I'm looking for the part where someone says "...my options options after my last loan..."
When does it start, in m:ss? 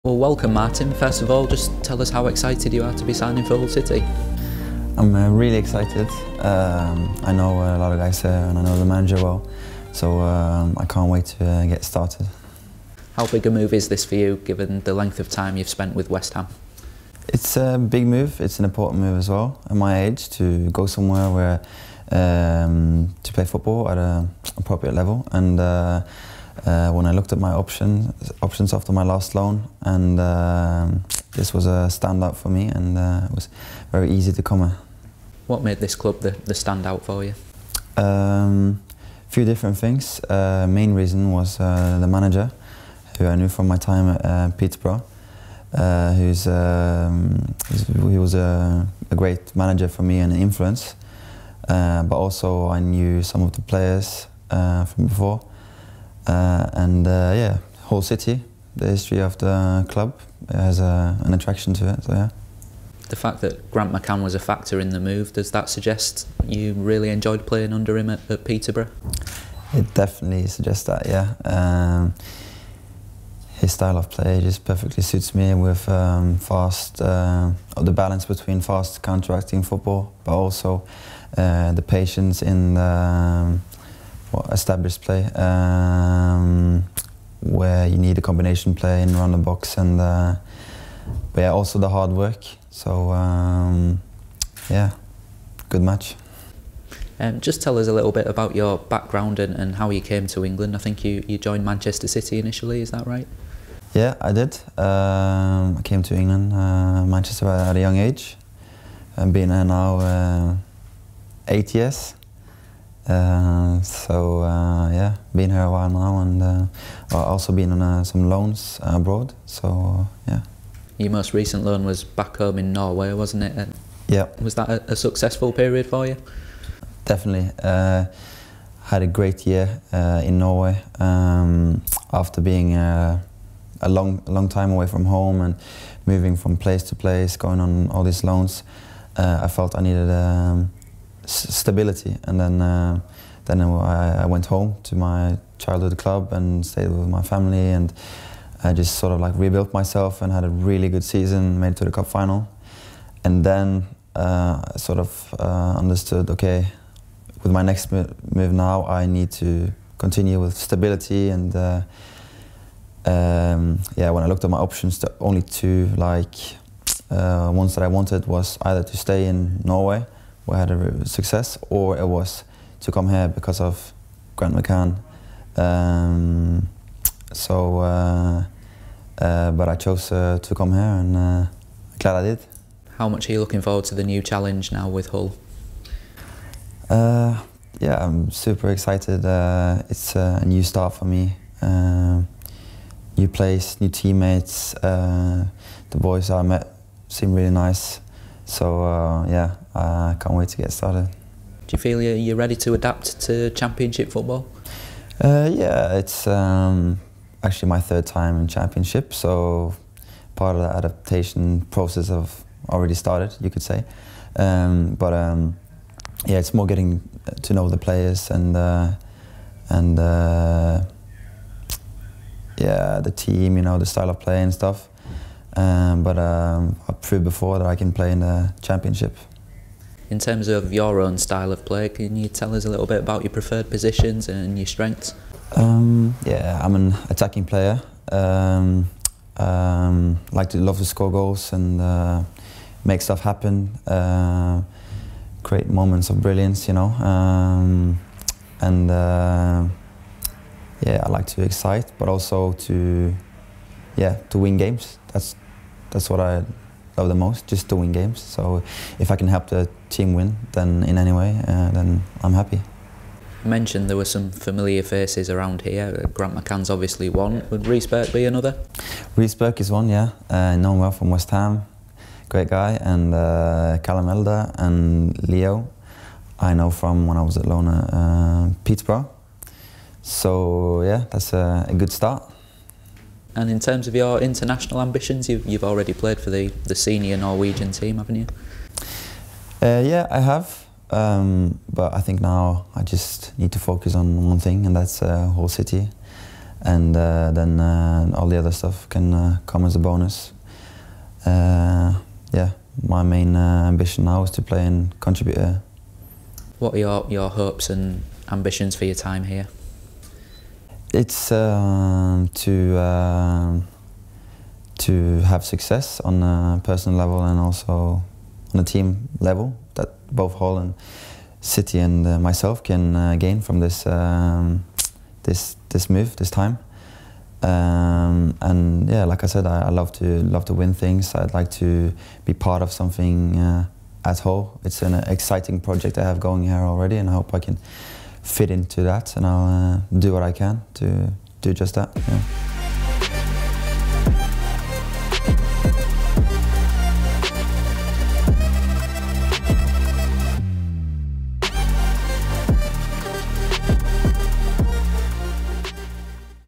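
0:27.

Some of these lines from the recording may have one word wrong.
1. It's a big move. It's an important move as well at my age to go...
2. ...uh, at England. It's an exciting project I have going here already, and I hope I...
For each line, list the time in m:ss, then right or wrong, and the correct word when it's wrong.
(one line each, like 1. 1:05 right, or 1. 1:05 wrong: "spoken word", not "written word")
1. 0:17 right
2. 5:33 wrong: "Hull", not "England".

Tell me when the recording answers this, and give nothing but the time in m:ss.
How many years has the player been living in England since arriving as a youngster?
1:51.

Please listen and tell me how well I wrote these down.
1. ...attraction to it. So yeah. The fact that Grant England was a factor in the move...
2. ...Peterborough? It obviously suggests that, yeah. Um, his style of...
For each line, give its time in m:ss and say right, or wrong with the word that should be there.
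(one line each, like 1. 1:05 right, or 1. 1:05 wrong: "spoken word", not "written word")
1. 1:01 wrong: "McCann", not "England"
2. 1:08 wrong: "definitely", not "obviously".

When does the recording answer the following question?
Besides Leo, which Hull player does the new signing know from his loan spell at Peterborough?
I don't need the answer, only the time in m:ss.
4:33.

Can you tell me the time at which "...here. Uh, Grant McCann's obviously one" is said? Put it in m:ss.
4:25.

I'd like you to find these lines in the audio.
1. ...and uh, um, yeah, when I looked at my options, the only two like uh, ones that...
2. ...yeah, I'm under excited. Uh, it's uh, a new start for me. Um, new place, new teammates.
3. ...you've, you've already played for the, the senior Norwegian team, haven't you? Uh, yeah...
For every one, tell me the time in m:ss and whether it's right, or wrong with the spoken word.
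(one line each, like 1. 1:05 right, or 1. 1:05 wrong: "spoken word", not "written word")
1. 2:41 right
2. 3:07 wrong: "super", not "under"
3. 4:45 right.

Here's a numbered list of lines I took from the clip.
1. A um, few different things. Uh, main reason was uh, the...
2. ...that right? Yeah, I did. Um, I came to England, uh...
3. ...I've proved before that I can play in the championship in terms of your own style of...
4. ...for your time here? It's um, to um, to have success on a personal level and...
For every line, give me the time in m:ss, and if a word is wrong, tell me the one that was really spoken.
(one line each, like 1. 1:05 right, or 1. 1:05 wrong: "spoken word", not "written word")
1. 0:37 right
2. 1:42 right
3. 3:46 right
4. 5:08 right.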